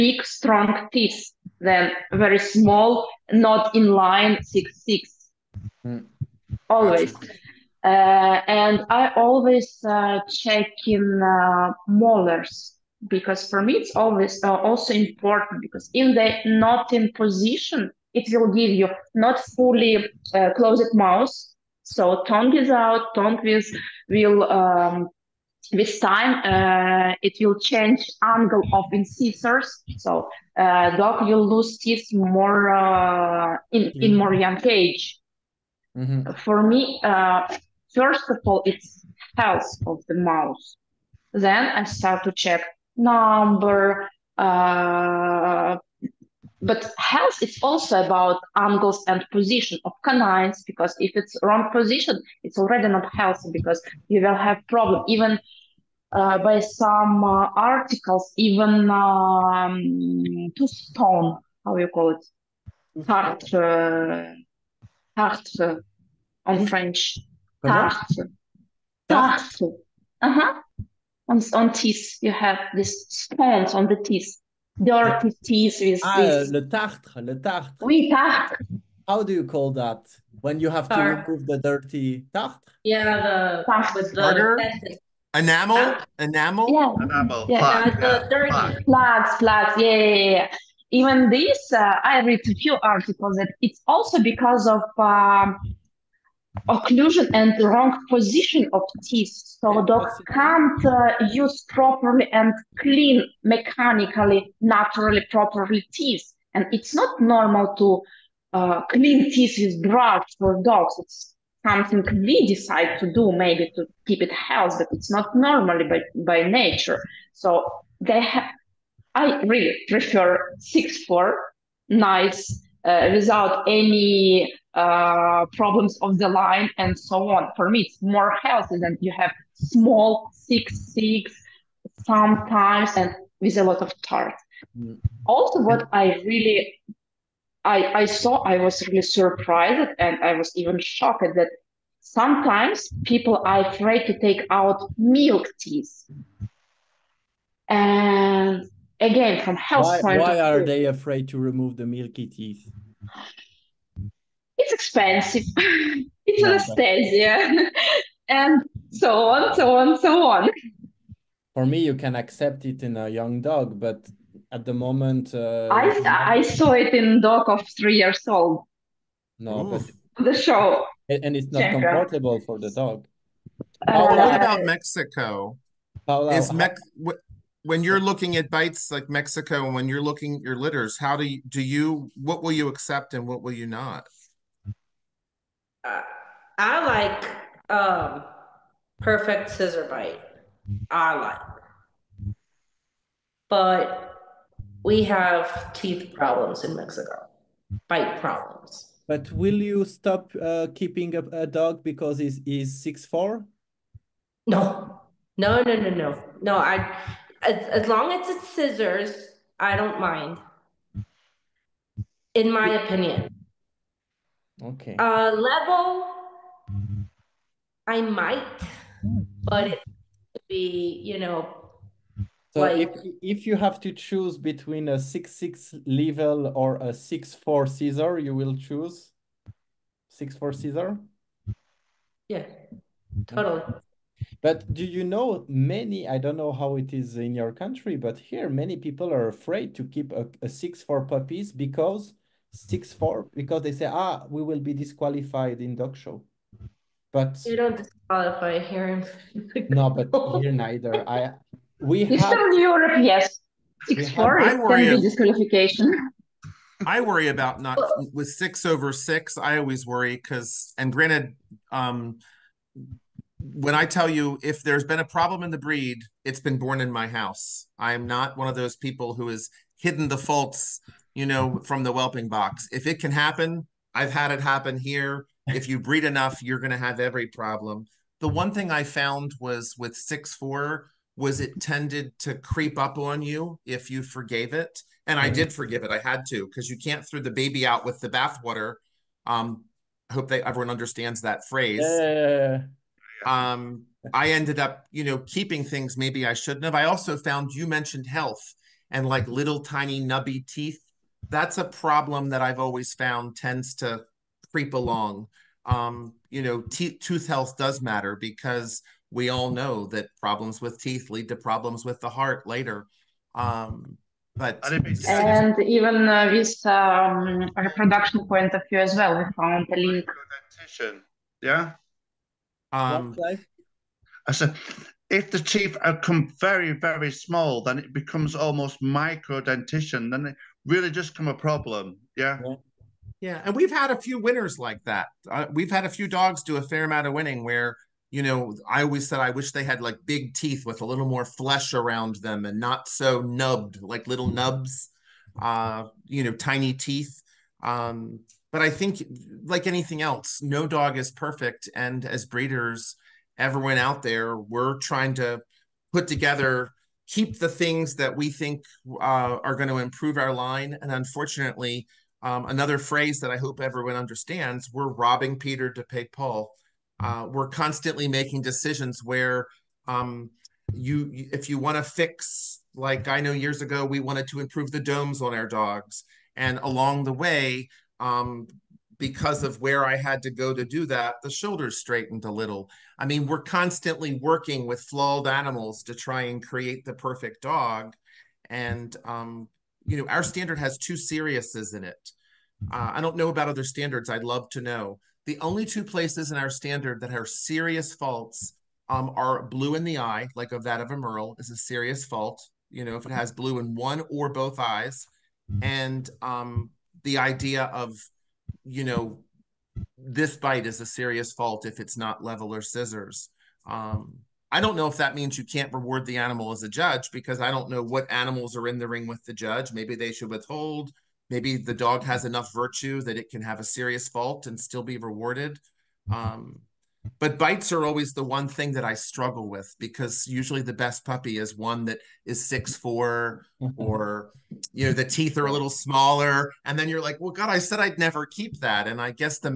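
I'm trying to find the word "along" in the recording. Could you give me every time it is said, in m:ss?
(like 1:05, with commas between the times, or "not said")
5:04, 6:16.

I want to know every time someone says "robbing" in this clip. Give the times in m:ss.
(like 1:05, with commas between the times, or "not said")
6:04.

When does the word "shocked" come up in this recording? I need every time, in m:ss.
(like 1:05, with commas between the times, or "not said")
2:20.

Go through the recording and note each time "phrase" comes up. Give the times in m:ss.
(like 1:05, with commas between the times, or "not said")
4:51, 6:02.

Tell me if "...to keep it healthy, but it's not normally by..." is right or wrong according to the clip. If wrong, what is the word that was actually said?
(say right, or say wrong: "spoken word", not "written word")
right.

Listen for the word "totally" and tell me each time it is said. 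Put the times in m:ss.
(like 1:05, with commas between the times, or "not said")
3:53.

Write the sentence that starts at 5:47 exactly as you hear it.
Um, but I think like anything else, no dog is perfect.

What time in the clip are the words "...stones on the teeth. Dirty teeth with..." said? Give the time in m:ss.
1:13.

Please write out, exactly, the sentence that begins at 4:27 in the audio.
I am not one of those people who has hidden the faults, you know, from the whelping box.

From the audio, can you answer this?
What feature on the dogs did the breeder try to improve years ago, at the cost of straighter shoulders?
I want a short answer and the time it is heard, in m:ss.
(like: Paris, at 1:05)
domes, at 6:14.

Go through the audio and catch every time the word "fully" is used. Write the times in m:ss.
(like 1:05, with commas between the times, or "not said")
0:19.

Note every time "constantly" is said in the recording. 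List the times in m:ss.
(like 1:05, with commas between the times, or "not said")
6:07, 6:23.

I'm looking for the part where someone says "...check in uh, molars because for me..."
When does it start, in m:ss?
0:10.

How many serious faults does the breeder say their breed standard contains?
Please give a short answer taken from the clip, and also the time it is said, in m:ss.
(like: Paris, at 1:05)
2, at 6:30.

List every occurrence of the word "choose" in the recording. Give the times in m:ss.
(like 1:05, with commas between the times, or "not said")
3:43, 3:48.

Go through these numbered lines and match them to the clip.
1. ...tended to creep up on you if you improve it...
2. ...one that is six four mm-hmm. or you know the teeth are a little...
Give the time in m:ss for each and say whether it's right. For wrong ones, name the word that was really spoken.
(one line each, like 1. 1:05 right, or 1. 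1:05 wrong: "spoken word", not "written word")
1. 4:41 wrong: "forgave", not "improve"
2. 7:11 right.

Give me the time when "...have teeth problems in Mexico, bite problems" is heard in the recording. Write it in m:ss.
3:15.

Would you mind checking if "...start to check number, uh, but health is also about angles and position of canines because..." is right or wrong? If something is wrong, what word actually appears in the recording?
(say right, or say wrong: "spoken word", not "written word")
right.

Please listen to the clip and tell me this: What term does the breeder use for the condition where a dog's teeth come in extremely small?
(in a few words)
micro dentition.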